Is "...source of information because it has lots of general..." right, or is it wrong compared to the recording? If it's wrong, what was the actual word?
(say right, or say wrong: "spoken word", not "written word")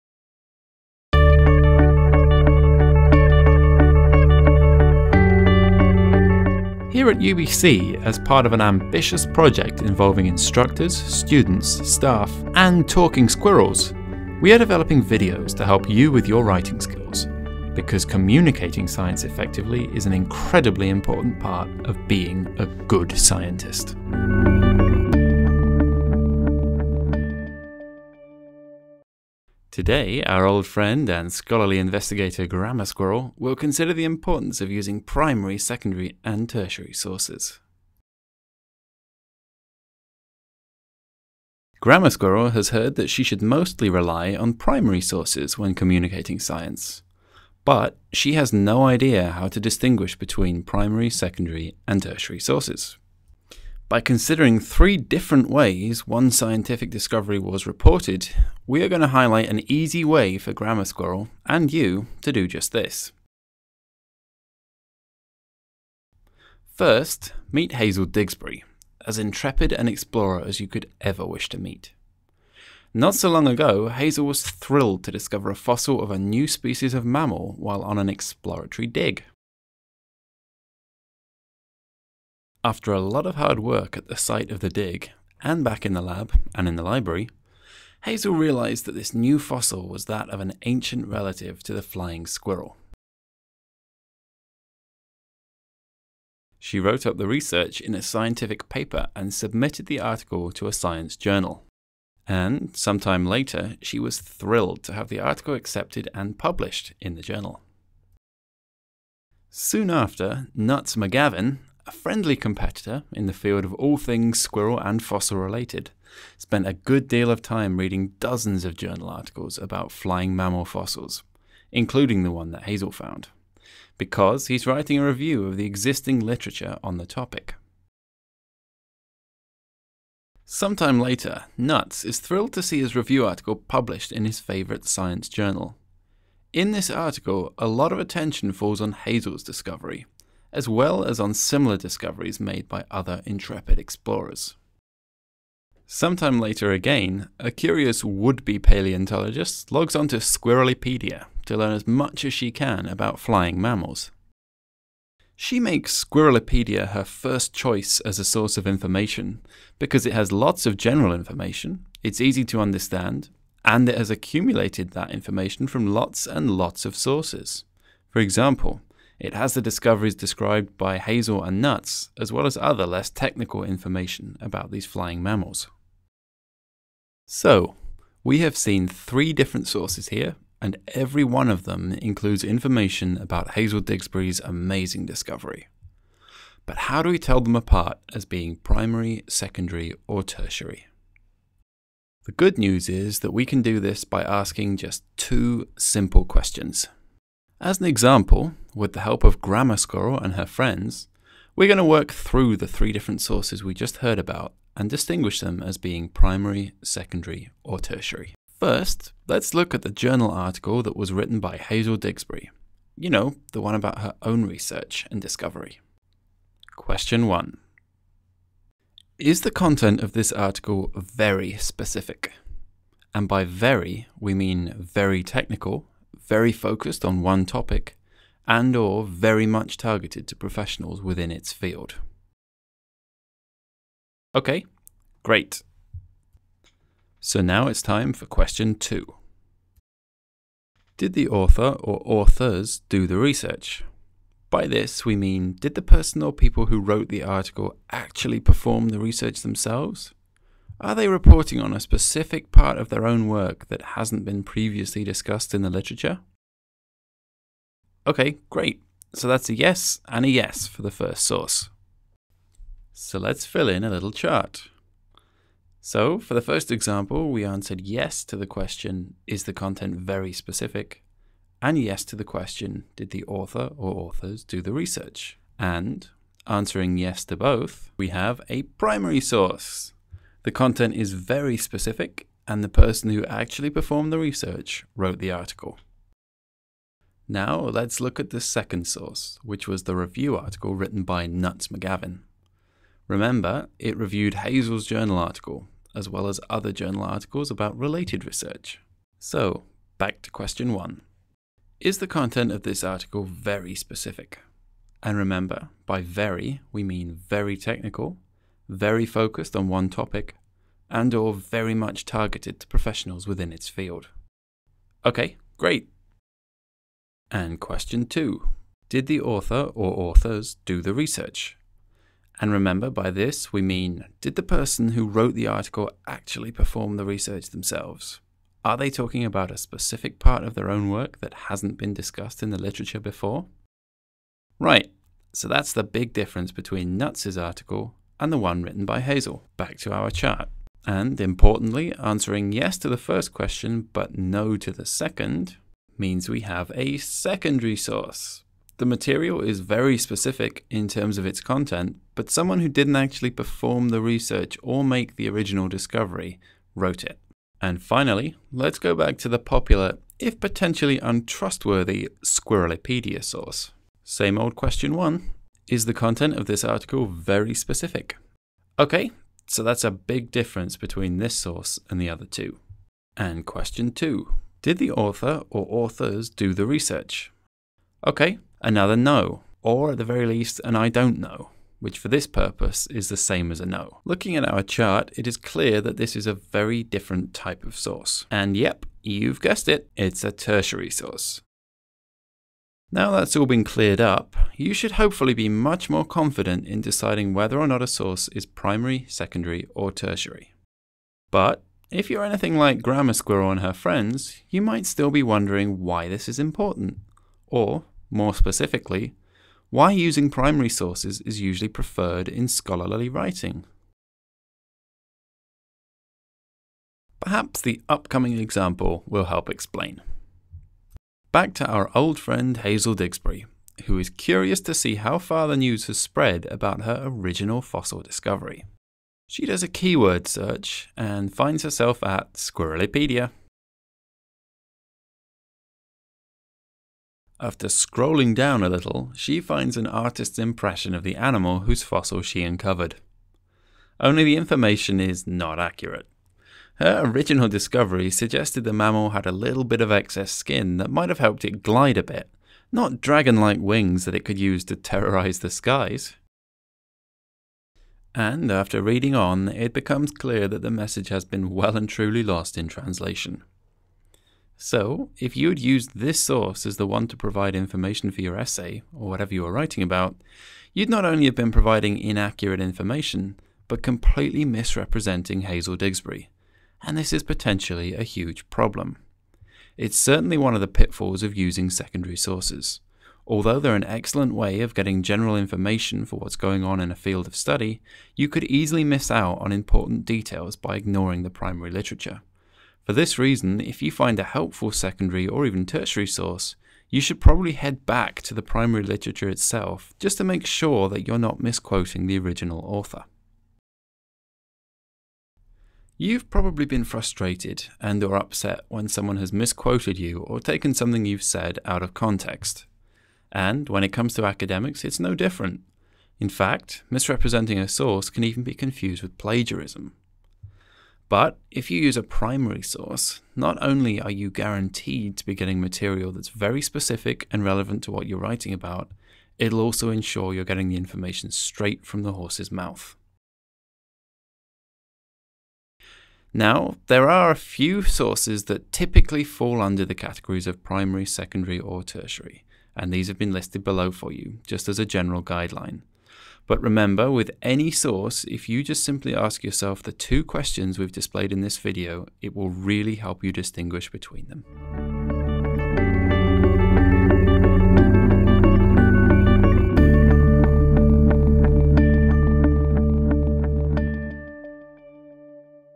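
right.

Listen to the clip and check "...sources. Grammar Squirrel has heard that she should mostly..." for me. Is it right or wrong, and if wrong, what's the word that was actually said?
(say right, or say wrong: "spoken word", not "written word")
right.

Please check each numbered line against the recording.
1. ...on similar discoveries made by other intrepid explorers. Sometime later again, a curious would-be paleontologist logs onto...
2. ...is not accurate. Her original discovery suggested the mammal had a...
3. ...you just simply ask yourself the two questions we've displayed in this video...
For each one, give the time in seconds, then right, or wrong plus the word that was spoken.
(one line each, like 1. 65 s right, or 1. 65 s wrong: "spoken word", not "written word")
1. 141 s right
2. 444 s right
3. 548 s right.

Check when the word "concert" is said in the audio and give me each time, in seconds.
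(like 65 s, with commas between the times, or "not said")
not said.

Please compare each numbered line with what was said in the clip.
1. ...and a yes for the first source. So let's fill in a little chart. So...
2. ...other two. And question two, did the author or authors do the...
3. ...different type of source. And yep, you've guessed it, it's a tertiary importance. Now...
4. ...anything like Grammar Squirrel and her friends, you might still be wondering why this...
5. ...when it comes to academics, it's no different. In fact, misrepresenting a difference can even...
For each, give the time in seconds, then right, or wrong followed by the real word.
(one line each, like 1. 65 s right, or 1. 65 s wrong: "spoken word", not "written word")
1. 260 s right
2. 372 s right
3. 386 s wrong: "source", not "importance"
4. 402 s right
5. 513 s wrong: "source", not "difference".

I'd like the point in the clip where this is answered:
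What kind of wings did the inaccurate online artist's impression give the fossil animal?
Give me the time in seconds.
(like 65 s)
453 s.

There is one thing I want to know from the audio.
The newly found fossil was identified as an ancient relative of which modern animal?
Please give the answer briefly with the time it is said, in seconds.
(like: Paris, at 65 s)
flying squirrel, at 91 s.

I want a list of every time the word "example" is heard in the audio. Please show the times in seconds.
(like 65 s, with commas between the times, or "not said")
168 s, 197 s, 266 s, 418 s.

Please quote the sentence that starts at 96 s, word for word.
She wrote up the research in a scientific paper and submitted the article to a science journal.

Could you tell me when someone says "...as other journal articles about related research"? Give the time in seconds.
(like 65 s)
296 s.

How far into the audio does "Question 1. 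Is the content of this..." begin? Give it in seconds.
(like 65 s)
216 s.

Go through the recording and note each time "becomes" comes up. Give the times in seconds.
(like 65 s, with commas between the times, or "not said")
459 s.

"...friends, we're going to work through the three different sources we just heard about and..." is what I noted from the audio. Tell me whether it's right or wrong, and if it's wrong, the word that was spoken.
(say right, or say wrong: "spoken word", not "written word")
right.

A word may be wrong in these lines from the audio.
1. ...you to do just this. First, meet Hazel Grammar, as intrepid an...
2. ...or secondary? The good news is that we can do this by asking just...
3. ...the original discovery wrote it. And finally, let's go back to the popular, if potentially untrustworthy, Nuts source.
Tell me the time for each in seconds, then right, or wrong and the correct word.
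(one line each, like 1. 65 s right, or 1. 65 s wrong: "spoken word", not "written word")
1. 61 s wrong: "Digsbury", not "Grammar"
2. 190 s wrong: "tertiary", not "secondary"
3. 355 s wrong: "Squirrelipedia", not "Nuts".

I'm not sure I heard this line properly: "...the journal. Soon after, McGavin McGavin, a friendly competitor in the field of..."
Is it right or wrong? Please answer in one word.
wrong.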